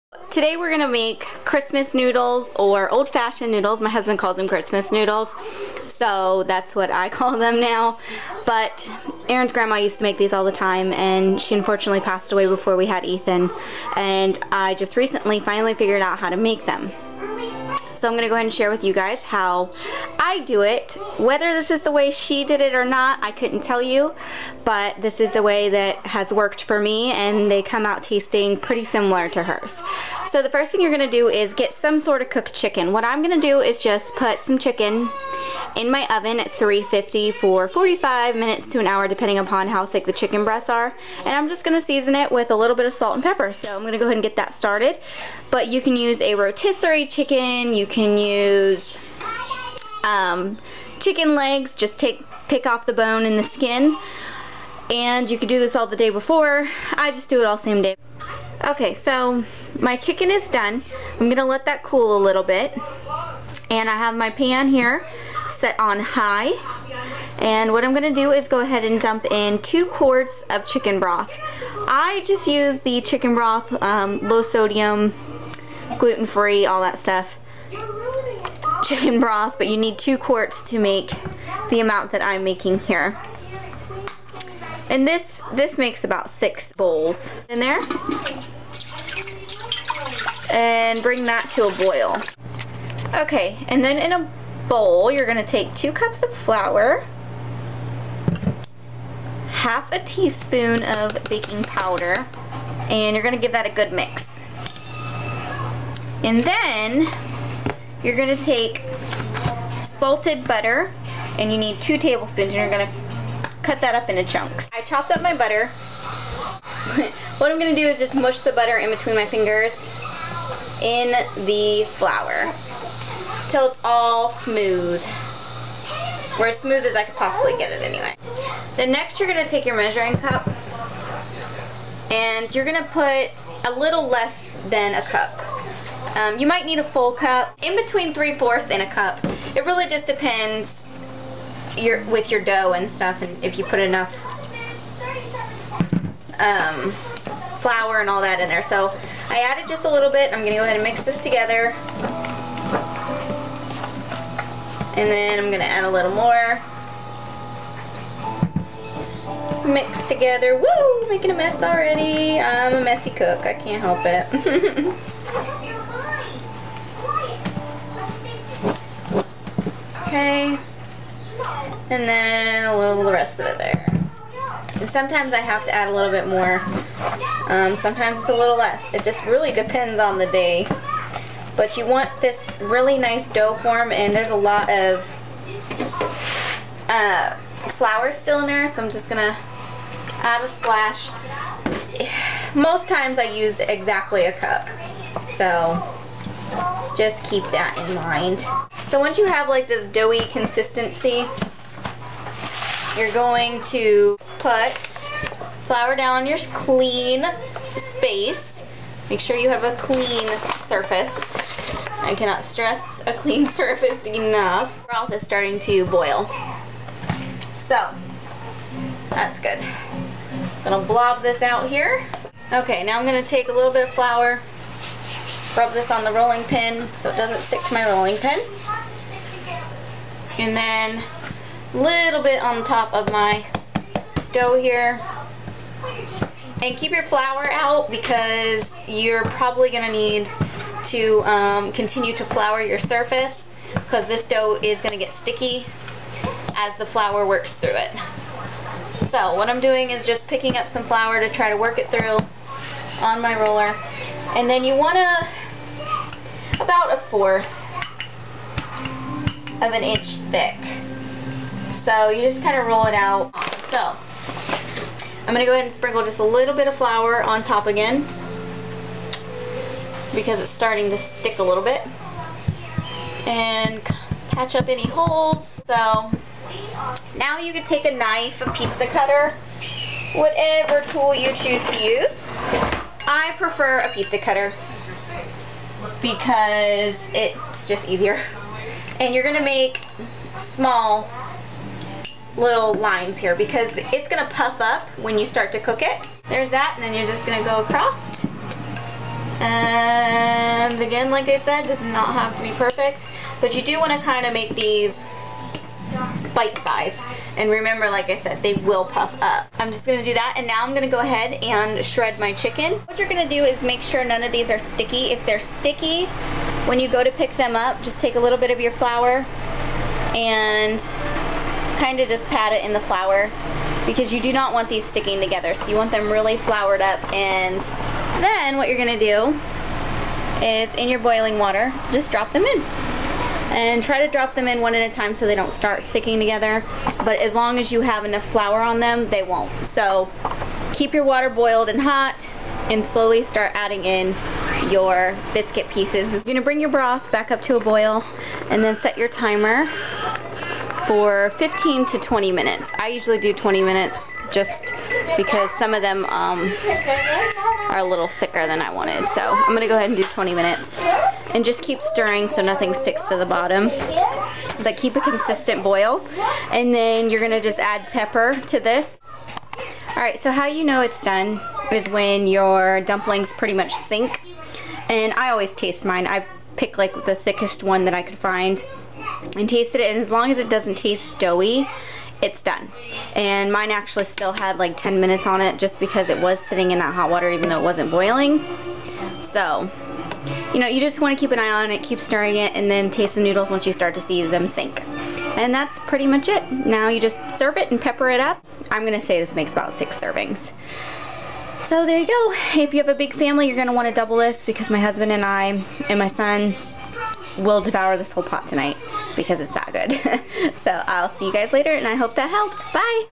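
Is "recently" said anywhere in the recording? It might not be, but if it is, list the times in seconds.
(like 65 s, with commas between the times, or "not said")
14 s.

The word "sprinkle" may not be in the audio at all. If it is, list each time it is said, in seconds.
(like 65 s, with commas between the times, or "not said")
265 s.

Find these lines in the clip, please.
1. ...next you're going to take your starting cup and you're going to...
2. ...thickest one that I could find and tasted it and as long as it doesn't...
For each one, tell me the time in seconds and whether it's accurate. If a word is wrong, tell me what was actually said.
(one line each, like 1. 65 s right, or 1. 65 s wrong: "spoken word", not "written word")
1. 128 s wrong: "measuring", not "starting"
2. 377 s right.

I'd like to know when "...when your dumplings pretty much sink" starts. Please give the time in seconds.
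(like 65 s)
371 s.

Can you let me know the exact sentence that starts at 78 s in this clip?
Chicken broth, but you need two quarts to make the amount that I'm making here.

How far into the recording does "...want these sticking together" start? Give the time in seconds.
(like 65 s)
324 s.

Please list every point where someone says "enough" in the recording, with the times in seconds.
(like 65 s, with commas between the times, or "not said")
143 s, 214 s, 338 s.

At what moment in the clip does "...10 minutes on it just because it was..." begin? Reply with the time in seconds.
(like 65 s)
384 s.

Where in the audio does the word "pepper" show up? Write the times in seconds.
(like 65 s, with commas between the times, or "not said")
43 s, 367 s, 397 s.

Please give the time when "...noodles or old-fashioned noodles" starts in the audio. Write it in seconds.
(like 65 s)
1 s.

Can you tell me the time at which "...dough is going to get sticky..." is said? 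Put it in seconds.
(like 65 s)
244 s.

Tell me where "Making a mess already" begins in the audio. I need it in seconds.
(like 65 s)
161 s.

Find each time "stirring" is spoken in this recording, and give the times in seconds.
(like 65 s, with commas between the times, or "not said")
361 s, 391 s.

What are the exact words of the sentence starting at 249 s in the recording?
So what I'm doing is just picking up some flour to try to work it through on my roller.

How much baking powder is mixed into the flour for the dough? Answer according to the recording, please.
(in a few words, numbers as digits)
Half a teaspoon.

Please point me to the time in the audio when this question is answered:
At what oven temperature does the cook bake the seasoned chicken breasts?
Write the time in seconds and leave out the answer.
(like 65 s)
36 s.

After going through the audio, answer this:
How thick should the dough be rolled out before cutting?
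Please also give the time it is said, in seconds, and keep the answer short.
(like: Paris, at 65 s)
A fourth of an inch, at 256 s.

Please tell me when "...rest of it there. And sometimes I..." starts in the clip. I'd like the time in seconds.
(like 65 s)
173 s.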